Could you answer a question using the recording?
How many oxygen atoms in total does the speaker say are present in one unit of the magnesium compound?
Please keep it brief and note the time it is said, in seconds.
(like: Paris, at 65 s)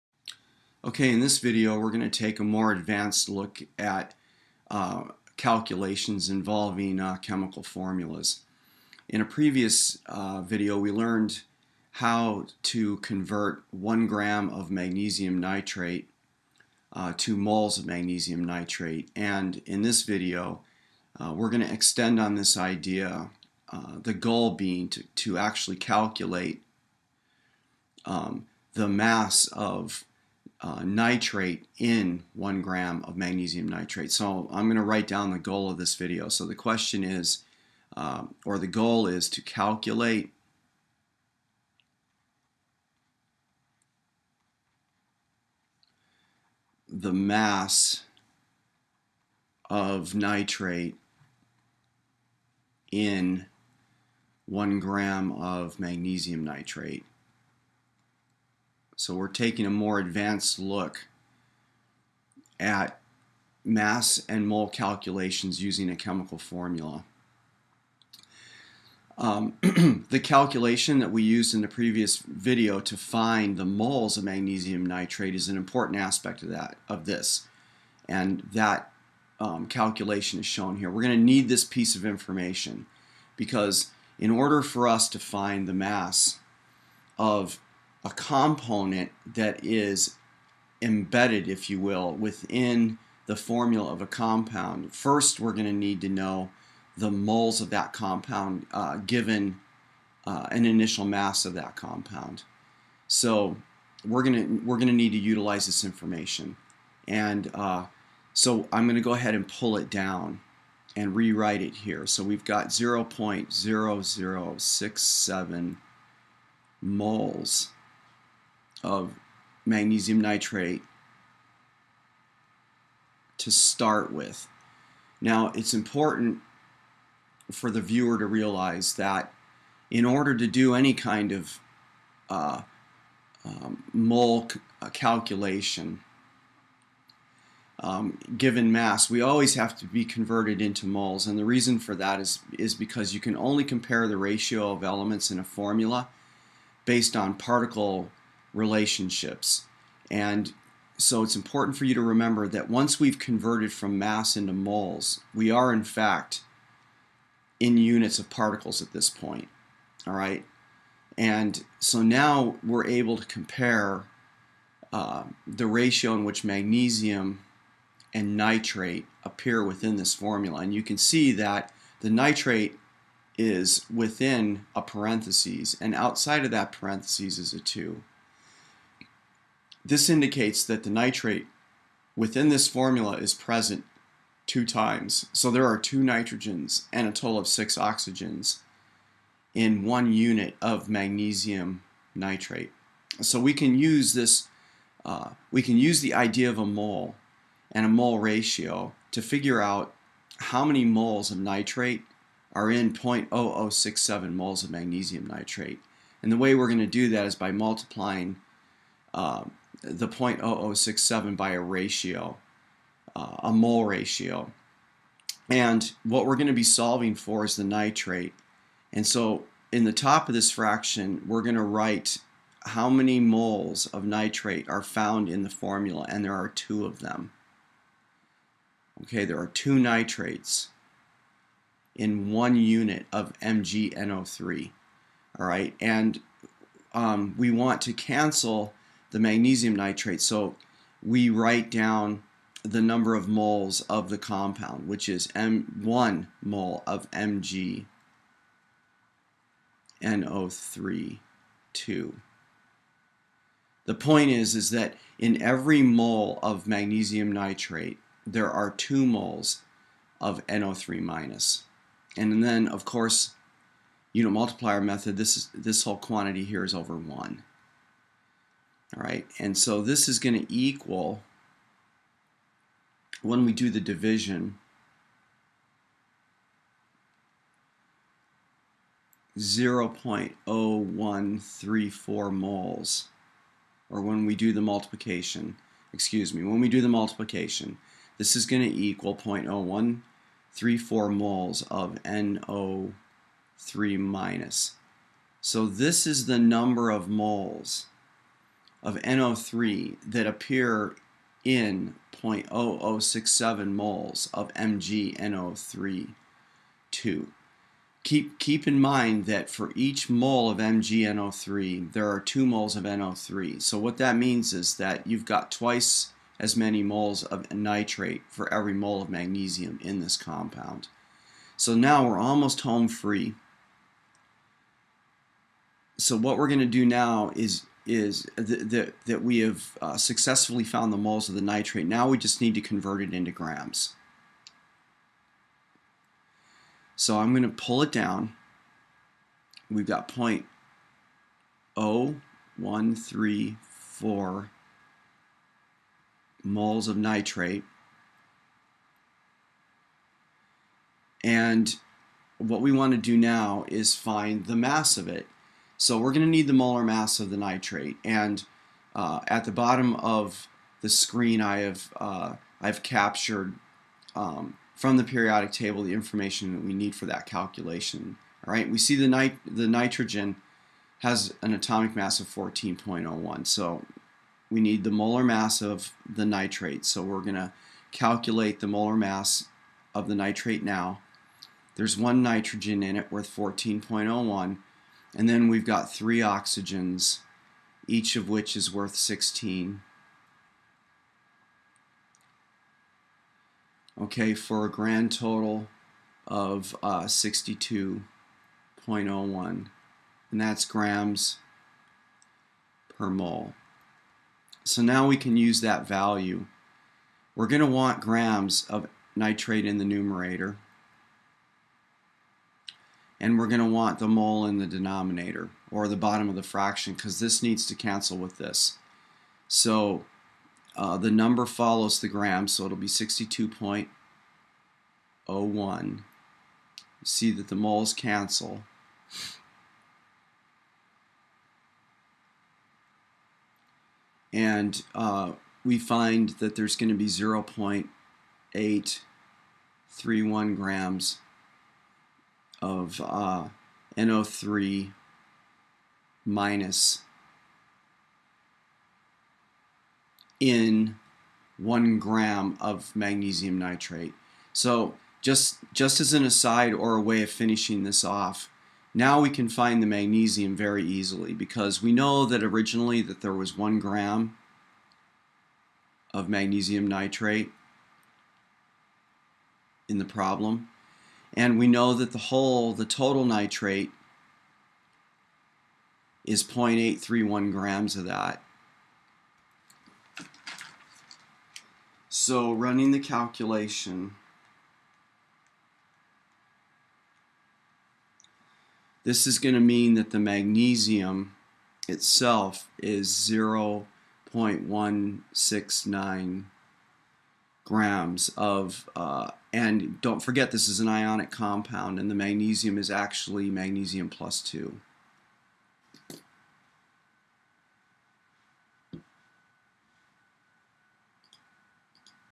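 six, at 187 s.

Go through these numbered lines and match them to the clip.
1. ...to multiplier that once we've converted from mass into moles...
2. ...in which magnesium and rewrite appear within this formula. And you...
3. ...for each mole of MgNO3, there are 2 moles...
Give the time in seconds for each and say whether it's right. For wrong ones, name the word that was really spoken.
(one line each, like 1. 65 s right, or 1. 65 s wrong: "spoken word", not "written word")
1. 151 s wrong: "remember", not "multiplier"
2. 166 s wrong: "nitrate", not "rewrite"
3. 309 s right.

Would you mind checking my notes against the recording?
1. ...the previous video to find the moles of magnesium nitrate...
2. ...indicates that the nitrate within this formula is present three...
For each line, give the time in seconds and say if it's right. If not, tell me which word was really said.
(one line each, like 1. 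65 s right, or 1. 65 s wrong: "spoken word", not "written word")
1. 71 s right
2. 180 s wrong: "two", not "three".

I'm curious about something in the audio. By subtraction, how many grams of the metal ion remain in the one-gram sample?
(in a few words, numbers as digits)
0.169 grams.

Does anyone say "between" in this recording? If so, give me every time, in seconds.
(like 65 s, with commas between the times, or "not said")
not said.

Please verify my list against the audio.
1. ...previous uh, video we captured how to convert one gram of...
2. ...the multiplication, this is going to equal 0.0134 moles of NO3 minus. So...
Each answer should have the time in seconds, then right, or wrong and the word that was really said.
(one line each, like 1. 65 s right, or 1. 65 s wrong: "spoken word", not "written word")
1. 9 s wrong: "learned", not "captured"
2. 286 s right.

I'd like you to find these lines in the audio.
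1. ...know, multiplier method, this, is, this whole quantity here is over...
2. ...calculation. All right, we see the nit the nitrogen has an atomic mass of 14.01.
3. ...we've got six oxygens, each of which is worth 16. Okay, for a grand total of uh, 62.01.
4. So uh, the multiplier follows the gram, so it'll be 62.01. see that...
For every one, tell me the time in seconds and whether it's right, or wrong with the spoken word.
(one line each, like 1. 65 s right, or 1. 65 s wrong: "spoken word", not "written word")
1. 264 s right
2. 367 s right
3. 385 s wrong: "three", not "six"
4. 419 s wrong: "number", not "multiplier".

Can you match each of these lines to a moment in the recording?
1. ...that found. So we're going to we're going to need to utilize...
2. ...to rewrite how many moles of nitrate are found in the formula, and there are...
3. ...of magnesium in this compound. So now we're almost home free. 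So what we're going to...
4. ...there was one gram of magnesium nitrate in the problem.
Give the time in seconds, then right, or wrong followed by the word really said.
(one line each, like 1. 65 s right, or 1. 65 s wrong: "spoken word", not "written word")
1. 101 s wrong: "compound", not "found"
2. 221 s wrong: "write", not "rewrite"
3. 319 s right
4. 463 s right.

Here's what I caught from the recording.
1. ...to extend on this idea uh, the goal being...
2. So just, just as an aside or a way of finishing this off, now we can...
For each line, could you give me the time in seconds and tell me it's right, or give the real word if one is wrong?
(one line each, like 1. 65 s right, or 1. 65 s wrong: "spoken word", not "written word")
1. 21 s right
2. 454 s right.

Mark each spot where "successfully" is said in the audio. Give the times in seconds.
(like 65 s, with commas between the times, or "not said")
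329 s.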